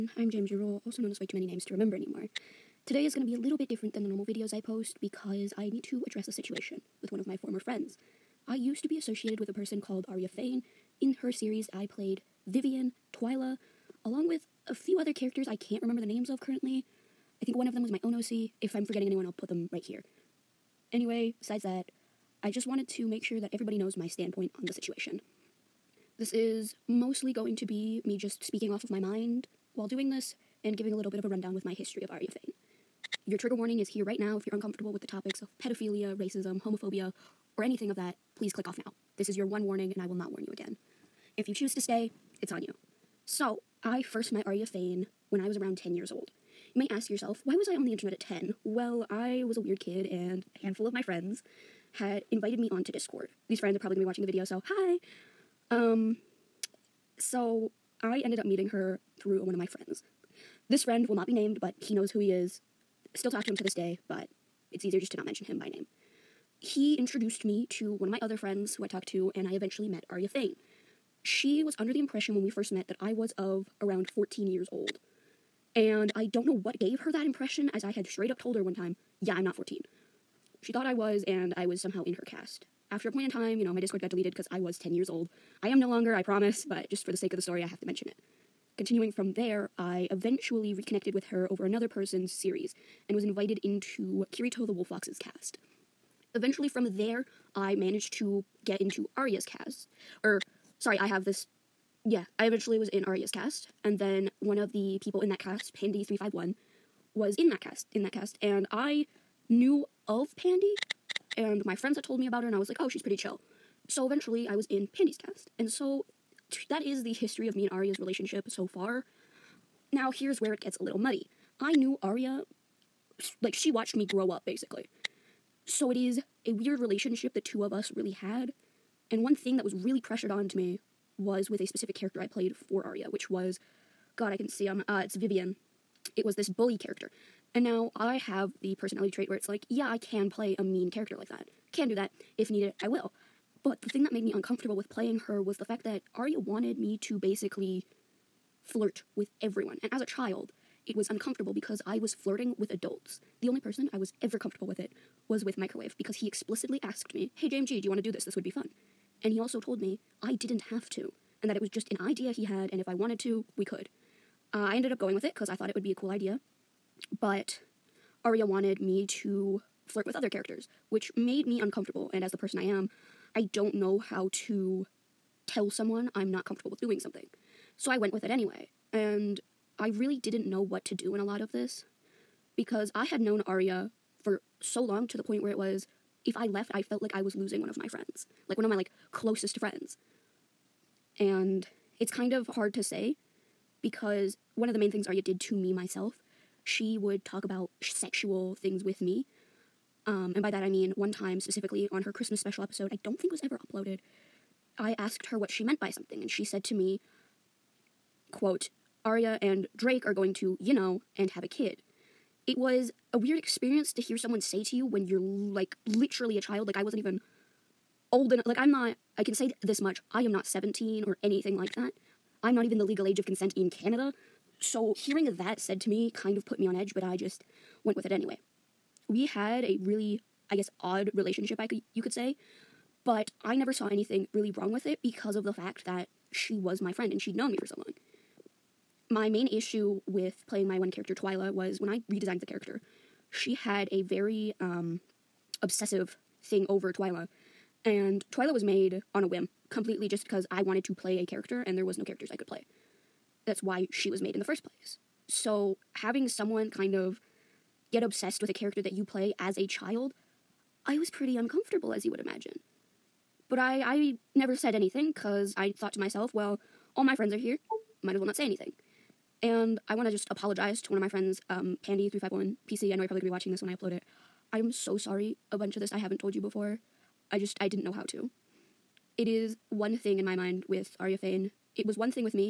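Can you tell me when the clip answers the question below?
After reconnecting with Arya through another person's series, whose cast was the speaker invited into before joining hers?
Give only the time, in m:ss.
1:34.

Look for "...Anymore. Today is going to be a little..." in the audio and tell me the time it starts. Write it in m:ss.
0:01.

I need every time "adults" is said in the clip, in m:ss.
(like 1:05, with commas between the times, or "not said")
2:32.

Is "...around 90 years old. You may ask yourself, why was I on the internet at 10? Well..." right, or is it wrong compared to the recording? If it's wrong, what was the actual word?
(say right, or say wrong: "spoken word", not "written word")
wrong: "10", not "90".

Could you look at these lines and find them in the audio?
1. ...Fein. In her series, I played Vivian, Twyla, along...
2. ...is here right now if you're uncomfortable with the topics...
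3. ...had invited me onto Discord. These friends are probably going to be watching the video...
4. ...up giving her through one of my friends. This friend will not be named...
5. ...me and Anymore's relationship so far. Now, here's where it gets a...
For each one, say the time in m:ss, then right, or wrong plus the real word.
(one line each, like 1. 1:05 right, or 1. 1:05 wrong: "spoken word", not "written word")
1. 0:10 right
2. 0:33 right
3. 0:51 right
4. 0:58 wrong: "meeting", not "giving"
5. 1:57 wrong: "Arya", not "Anymore".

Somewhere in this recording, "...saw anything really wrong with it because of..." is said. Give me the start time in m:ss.
3:53.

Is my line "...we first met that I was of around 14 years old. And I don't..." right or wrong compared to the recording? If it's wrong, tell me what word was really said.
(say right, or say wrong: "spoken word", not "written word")
right.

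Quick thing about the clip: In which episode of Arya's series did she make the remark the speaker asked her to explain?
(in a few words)
Christmas special.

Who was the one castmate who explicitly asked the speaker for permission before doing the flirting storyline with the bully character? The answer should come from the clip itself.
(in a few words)
Microwave.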